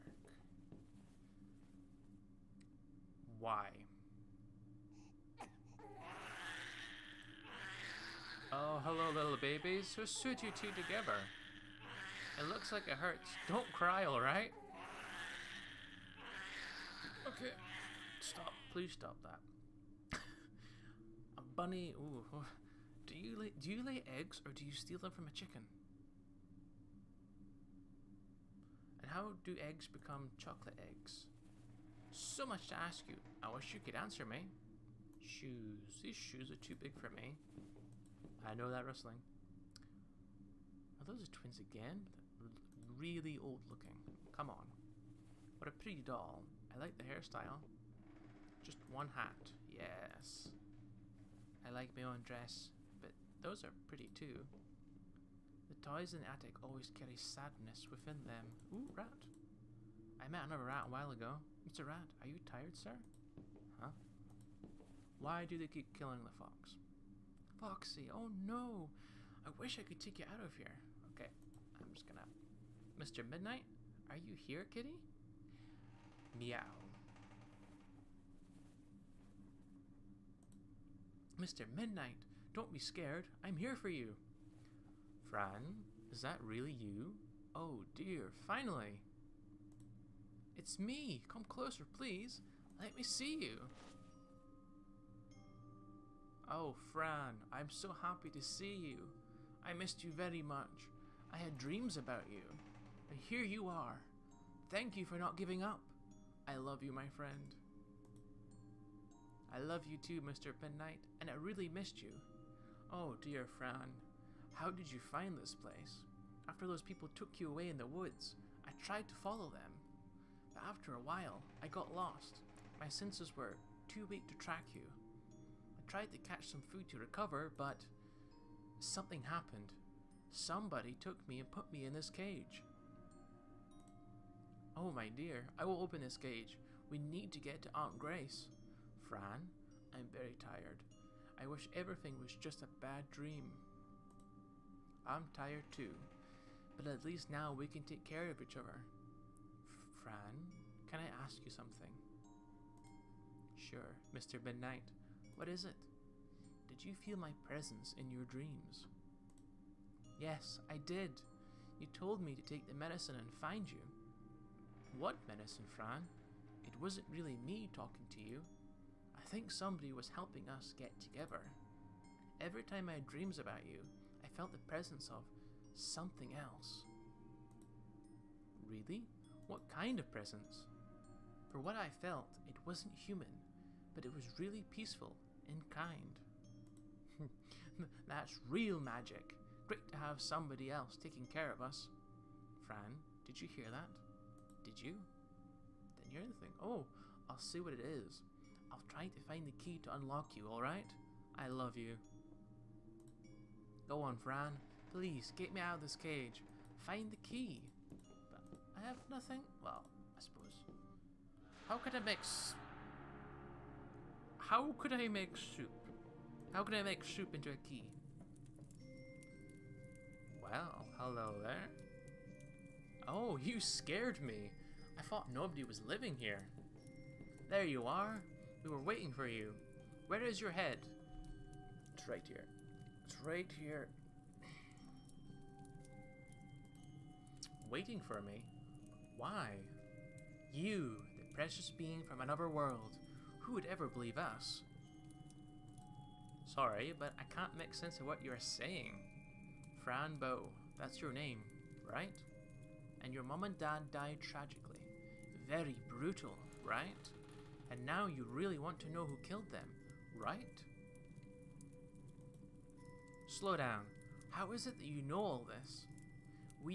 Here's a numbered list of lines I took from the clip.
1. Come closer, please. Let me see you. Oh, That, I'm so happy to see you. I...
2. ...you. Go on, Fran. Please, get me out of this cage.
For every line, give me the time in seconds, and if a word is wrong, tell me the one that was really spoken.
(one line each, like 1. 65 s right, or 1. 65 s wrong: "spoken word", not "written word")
1. 91 s wrong: "Fran", not "That"
2. 201 s right.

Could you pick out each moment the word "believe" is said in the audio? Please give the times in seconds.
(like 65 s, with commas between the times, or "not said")
243 s.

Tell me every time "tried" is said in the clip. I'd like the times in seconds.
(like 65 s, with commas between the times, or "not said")
118 s, 125 s.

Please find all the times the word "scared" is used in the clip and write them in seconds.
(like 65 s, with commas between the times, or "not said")
82 s, 223 s.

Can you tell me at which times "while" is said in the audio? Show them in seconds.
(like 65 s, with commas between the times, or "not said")
60 s, 120 s.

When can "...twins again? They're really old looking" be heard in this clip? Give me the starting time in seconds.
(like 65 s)
41 s.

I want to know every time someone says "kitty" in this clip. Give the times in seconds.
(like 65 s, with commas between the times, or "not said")
74 s.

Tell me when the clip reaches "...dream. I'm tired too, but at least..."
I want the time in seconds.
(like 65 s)
143 s.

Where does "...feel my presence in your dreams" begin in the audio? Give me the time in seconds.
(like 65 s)
157 s.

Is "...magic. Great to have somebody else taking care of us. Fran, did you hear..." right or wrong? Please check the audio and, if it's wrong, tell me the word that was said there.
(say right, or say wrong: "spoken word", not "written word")
right.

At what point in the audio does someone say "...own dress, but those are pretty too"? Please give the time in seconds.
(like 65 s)
52 s.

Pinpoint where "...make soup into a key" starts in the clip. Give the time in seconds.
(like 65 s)
216 s.